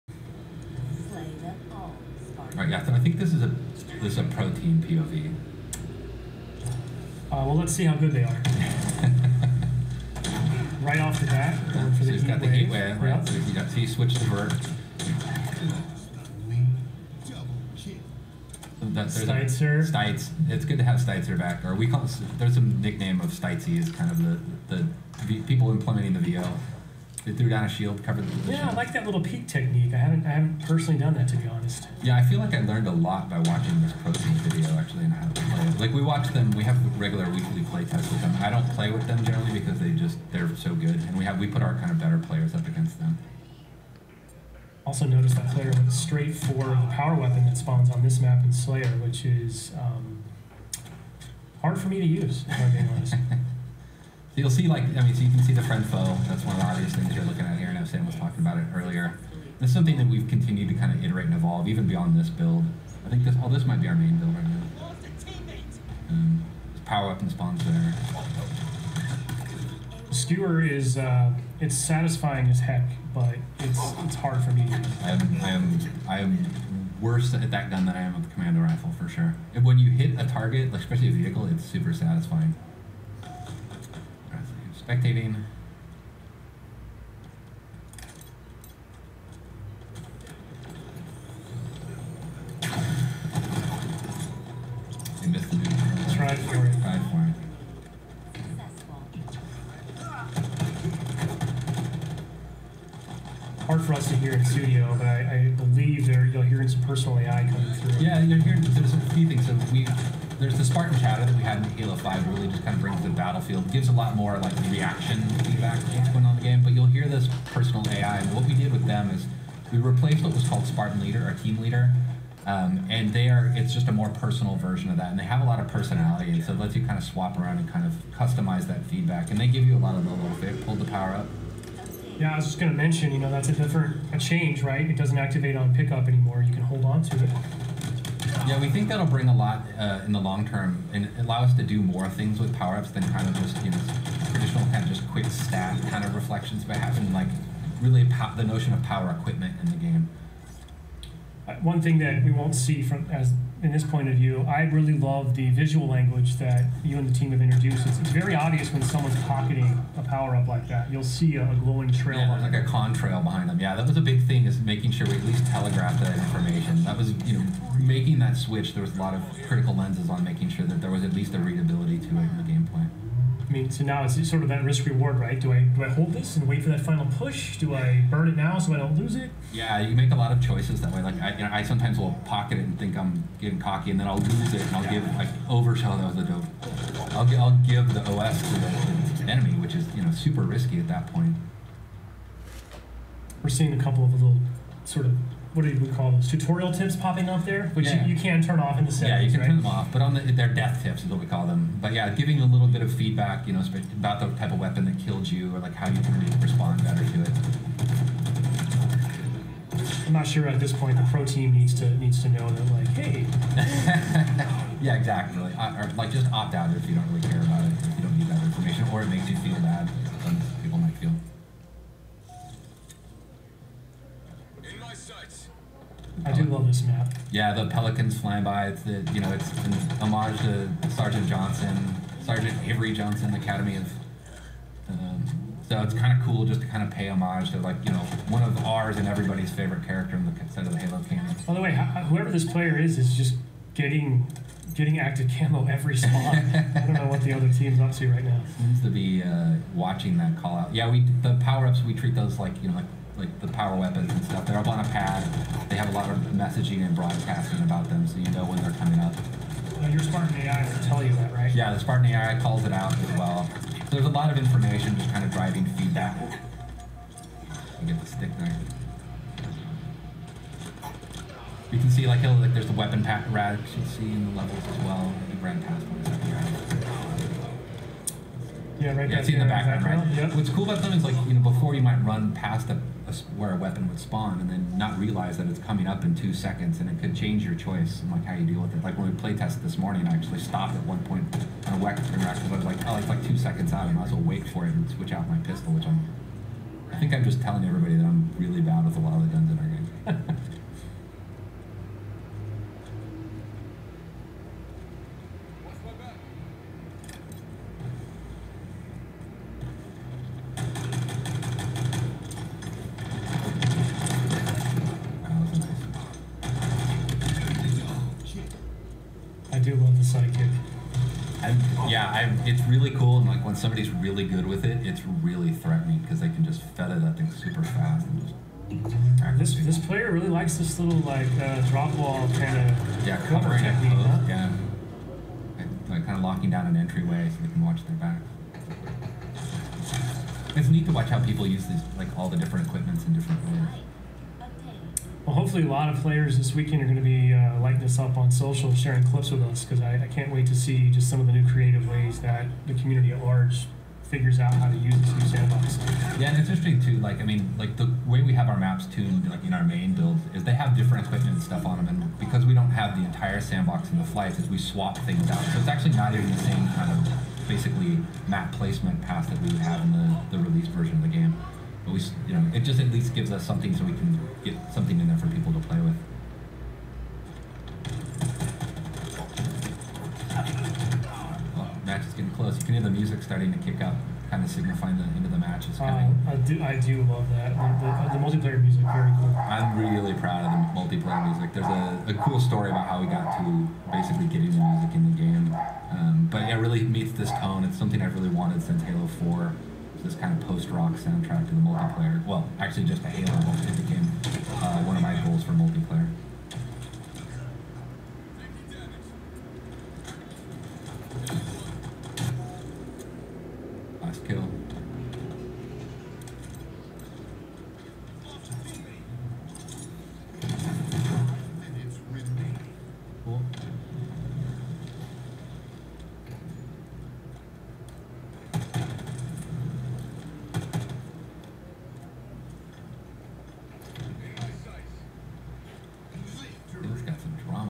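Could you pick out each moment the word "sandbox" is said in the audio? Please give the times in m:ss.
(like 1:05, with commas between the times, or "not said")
5:55, 6:03.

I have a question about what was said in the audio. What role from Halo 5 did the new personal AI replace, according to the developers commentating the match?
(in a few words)
Spartan Leader.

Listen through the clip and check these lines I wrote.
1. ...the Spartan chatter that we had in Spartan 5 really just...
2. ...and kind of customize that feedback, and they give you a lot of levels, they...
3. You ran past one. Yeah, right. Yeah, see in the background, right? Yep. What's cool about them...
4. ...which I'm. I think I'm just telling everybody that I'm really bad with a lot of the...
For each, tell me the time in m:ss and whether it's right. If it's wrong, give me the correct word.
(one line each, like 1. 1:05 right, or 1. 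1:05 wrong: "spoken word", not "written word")
1. 1:50 wrong: "Halo", not "Spartan"
2. 2:07 right
3. 4:35 right
4. 4:55 right.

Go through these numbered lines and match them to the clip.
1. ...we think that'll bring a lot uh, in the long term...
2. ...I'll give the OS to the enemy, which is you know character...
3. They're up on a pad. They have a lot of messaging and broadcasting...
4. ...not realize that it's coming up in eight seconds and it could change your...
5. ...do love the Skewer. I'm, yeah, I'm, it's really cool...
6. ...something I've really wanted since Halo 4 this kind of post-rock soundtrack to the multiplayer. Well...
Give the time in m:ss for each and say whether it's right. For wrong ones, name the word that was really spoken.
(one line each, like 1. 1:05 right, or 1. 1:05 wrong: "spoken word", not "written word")
1. 2:18 right
2. 3:07 wrong: "super", not "character"
3. 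4:14 right
4. 4:44 wrong: "two", not "eight"
5. 5:19 wrong: "Sidekick", not "Skewer"
6. 6:37 right.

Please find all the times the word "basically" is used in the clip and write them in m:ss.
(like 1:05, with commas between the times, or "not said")
6:07, 6:33.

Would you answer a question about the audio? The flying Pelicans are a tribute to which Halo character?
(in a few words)
Sergeant Avery Johnson.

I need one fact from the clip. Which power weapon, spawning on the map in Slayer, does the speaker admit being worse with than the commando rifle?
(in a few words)
Skewer.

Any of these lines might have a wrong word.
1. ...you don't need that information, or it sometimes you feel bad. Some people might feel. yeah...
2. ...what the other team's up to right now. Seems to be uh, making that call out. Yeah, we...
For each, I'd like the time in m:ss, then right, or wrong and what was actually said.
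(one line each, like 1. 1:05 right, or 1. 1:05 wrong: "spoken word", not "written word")
1. 3:37 wrong: "makes", not "sometimes"
2. 4:07 wrong: "watching", not "making".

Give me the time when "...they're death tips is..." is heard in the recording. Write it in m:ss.
3:20.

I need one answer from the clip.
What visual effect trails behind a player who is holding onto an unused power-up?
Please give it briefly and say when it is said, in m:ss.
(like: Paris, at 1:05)
A contrail, at 2:42.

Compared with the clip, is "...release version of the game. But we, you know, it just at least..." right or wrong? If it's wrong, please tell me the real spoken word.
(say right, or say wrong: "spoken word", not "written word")
right.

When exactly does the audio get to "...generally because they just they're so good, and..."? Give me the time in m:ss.
0:39.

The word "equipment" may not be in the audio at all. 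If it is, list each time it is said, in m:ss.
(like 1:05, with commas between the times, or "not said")
2:29, 5:42, 6:01.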